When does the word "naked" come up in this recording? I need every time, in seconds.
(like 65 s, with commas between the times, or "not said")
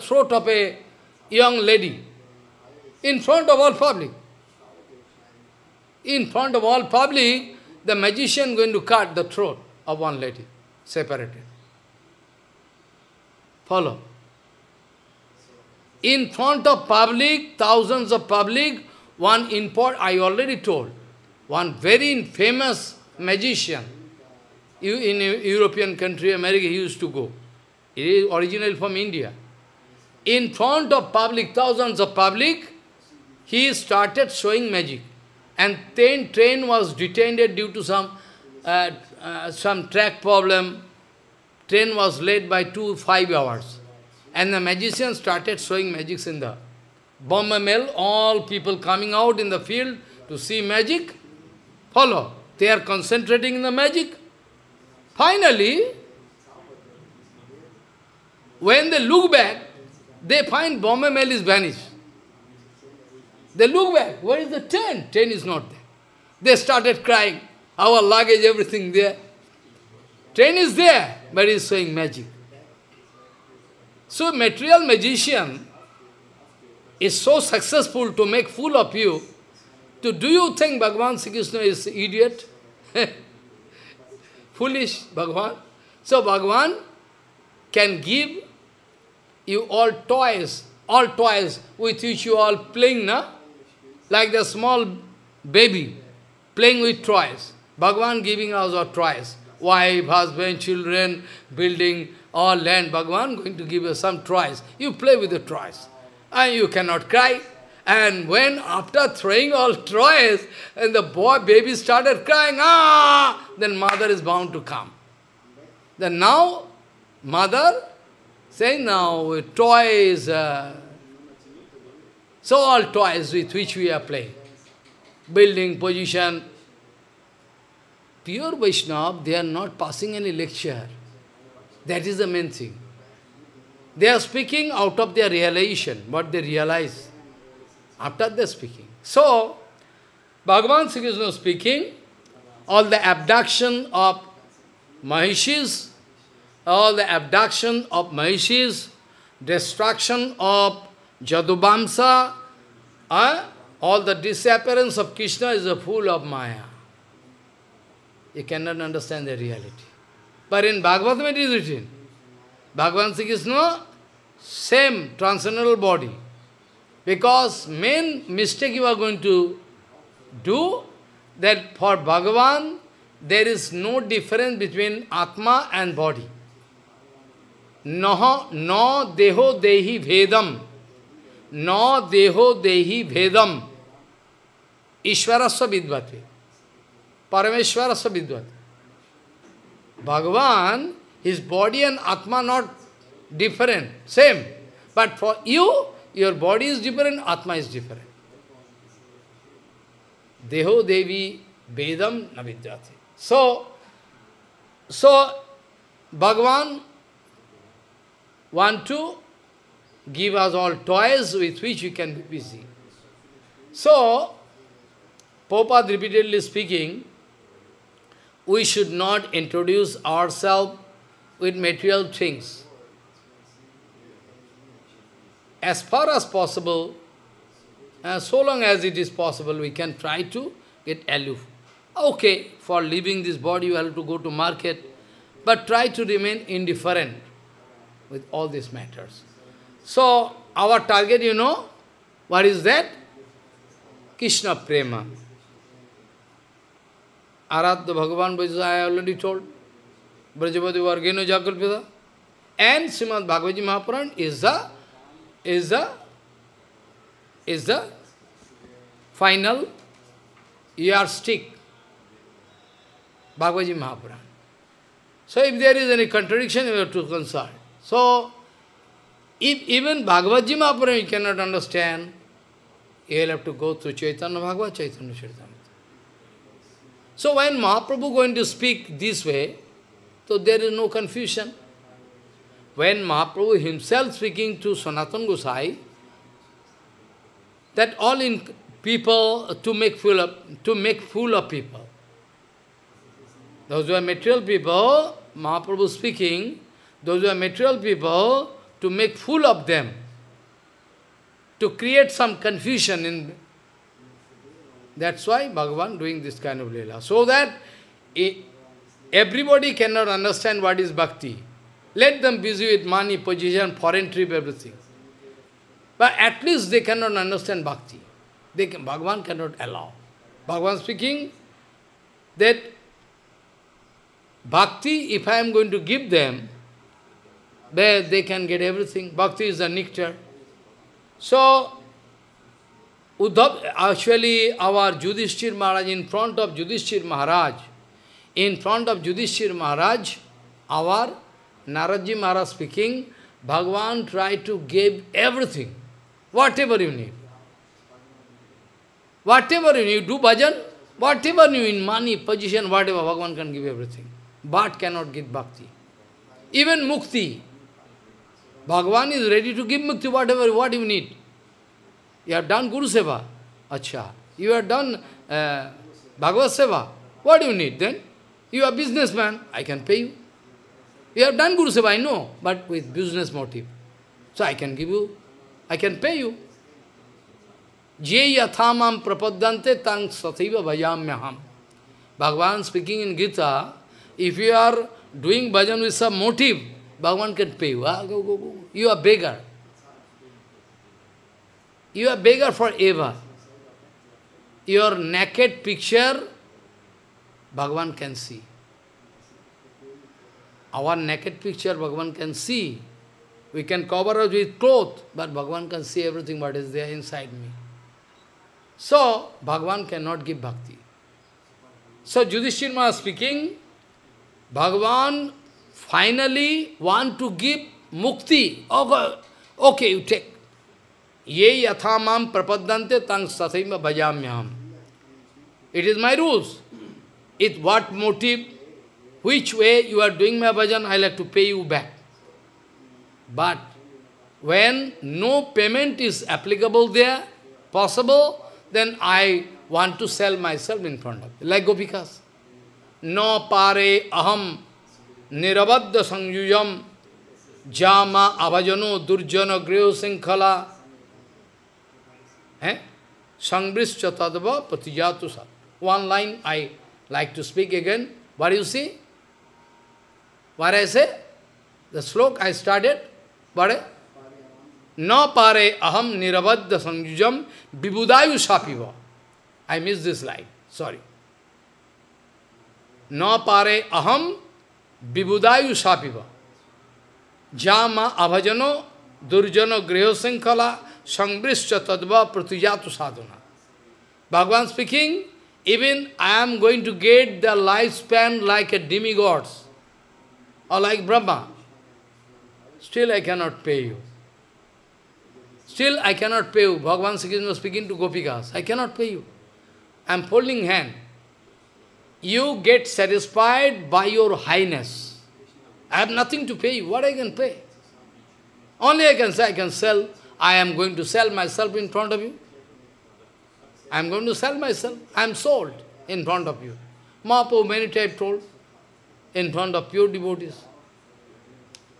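394 s, 400 s.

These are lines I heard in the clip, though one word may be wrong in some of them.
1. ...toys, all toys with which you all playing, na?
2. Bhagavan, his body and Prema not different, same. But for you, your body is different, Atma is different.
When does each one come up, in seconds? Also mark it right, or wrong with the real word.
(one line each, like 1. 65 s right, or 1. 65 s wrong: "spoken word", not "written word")
1. 90 s right
2. 190 s wrong: "Atma", not "Prema".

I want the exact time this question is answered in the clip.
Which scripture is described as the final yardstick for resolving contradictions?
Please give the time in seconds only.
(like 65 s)
252 s.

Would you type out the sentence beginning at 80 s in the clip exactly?
To do you think Bhagavan Sri Krishna is idiot?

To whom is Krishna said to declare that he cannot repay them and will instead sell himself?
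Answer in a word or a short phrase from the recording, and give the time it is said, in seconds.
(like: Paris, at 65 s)
Gopikas, at 497 s.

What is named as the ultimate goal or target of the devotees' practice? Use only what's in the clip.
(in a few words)
Krishna Prema.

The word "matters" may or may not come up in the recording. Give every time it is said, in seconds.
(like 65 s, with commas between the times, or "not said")
238 s.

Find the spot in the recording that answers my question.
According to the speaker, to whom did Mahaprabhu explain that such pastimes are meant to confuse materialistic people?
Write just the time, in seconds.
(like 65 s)
284 s.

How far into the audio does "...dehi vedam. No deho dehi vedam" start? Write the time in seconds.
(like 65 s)
179 s.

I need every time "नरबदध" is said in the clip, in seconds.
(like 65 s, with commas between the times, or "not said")
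445 s, 466 s.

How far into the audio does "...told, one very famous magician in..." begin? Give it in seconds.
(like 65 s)
20 s.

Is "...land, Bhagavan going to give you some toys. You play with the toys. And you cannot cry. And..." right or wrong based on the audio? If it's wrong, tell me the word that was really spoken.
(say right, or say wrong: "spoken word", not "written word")
right.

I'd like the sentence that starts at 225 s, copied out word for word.
As far as possible, uh, so long as it is possible, we can try to get aloof.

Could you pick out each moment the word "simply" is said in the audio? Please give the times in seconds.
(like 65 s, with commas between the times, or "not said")
not said.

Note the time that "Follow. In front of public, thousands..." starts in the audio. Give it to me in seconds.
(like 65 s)
13 s.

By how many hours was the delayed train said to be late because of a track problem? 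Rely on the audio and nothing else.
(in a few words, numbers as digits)
5.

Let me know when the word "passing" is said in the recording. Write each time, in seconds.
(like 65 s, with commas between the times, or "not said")
129 s.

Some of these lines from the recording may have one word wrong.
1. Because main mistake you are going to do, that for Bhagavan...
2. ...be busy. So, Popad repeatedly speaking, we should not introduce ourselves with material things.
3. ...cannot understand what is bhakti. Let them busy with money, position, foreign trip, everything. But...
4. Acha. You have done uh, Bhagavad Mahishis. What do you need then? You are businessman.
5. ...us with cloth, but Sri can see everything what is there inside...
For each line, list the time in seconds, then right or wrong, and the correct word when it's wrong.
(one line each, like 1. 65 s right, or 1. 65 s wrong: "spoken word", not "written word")
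1. 167 s right
2. 212 s right
3. 309 s right
4. 363 s wrong: "Seva", not "Mahishis"
5. 404 s wrong: "Bhagavan", not "Sri".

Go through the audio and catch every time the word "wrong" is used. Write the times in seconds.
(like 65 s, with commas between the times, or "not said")
not said.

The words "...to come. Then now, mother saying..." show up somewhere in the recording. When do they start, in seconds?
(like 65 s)
114 s.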